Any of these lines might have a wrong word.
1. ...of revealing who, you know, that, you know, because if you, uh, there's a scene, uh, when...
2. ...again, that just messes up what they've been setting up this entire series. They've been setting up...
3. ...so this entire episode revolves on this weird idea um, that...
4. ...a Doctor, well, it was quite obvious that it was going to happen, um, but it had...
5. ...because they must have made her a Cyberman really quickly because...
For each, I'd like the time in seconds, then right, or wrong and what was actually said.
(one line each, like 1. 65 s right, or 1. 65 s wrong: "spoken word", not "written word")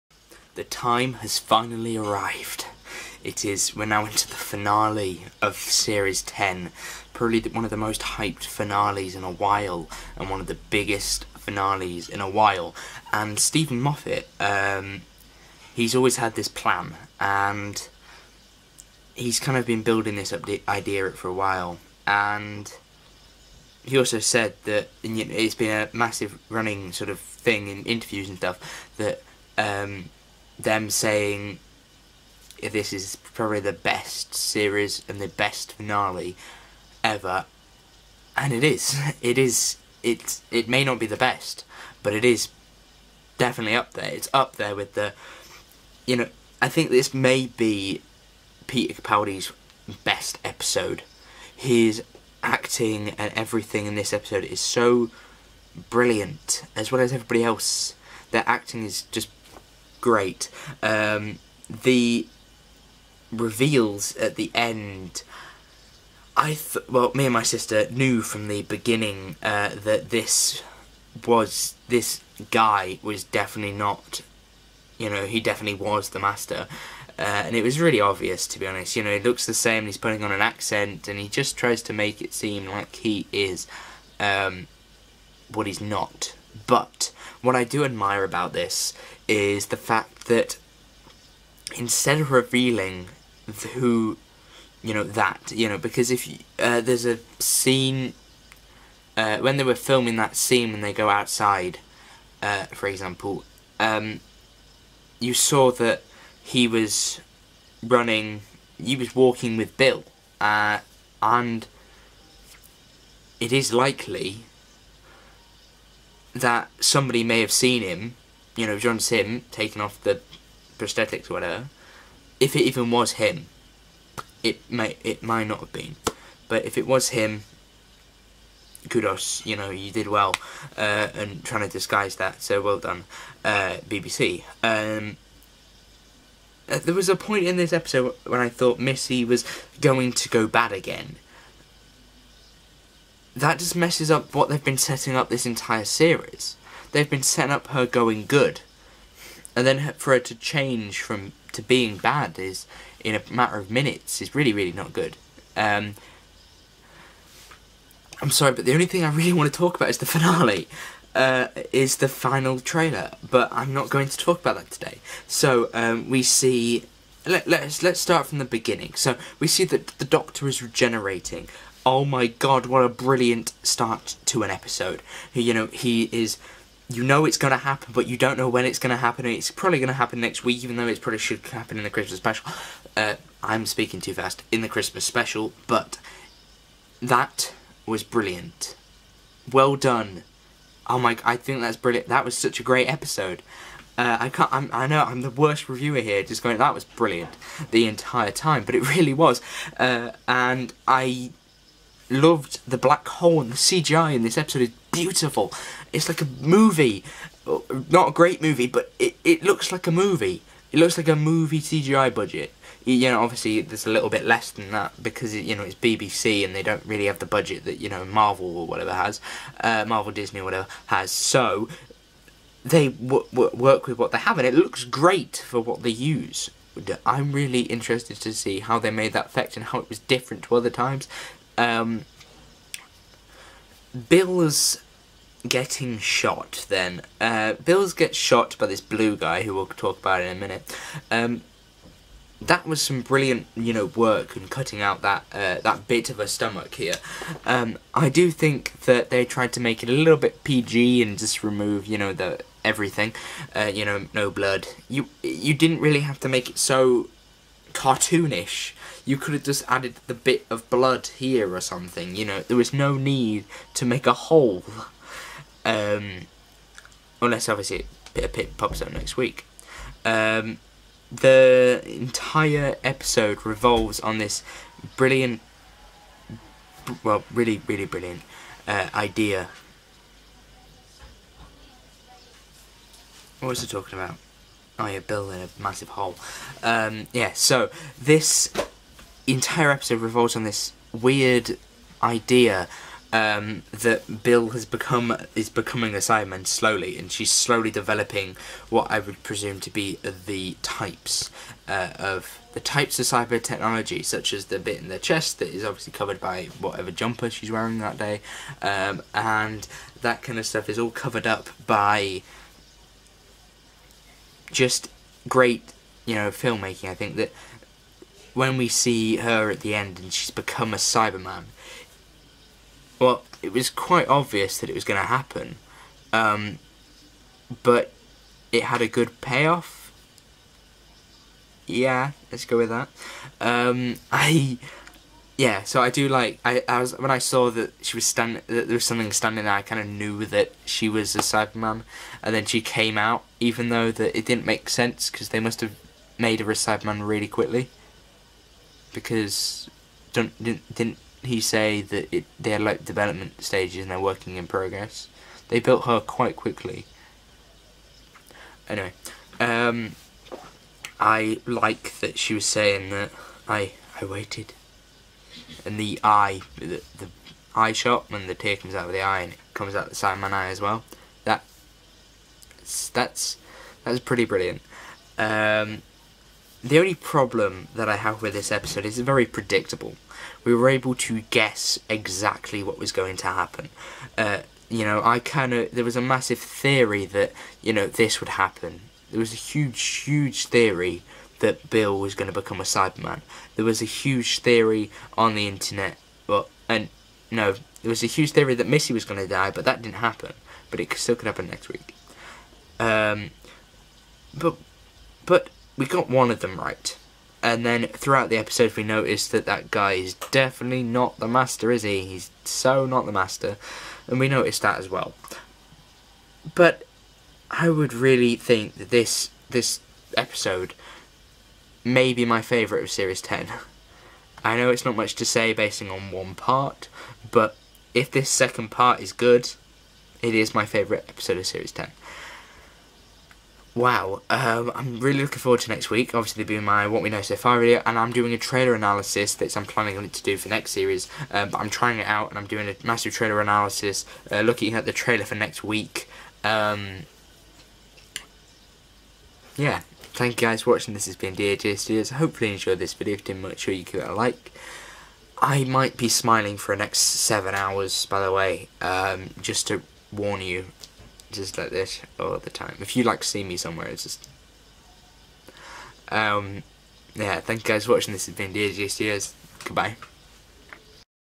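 1. 92 s right
2. 140 s right
3. 287 s right
4. 320 s wrong: "Cyberman", not "Doctor"
5. 345 s right.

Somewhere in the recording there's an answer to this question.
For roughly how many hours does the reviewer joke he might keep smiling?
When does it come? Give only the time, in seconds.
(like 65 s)
456 s.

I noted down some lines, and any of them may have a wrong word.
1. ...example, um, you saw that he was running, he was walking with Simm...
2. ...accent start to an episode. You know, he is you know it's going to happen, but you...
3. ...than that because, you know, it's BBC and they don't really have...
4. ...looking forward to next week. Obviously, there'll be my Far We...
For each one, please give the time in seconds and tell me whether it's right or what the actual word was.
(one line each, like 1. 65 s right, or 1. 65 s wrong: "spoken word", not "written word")
1. 102 s wrong: "Bill", not "Simm"
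2. 172 s wrong: "brilliant", not "accent"
3. 214 s right
4. 435 s wrong: "What", not "Far".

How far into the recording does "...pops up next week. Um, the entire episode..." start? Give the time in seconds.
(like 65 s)
268 s.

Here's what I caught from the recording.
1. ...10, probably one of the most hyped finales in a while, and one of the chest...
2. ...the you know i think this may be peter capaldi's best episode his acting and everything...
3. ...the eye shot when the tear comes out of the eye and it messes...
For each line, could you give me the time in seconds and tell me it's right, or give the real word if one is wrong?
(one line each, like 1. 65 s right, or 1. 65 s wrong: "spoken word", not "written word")
1. 6 s wrong: "biggest", not "chest"
2. 44 s right
3. 366 s wrong: "comes", not "messes".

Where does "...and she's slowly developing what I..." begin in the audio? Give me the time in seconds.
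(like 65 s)
296 s.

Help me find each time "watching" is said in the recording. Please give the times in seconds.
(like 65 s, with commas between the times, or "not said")
450 s, 467 s.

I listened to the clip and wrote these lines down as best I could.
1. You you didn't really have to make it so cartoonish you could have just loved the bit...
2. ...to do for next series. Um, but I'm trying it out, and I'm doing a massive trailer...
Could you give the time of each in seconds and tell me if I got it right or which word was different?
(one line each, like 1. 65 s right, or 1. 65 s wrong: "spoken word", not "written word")
1. 254 s wrong: "added", not "loved"
2. 440 s right.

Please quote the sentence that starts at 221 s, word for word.
So, they work with what they have and it looks great for what they use.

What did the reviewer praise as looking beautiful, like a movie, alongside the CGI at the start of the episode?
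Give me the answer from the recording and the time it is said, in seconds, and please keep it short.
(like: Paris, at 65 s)
the black hole, at 202 s.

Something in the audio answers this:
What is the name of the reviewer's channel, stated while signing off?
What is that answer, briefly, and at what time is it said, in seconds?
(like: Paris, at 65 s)
DAJ Studios, at 451 s.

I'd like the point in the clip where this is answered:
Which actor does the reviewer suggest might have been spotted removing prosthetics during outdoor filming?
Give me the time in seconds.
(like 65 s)
118 s.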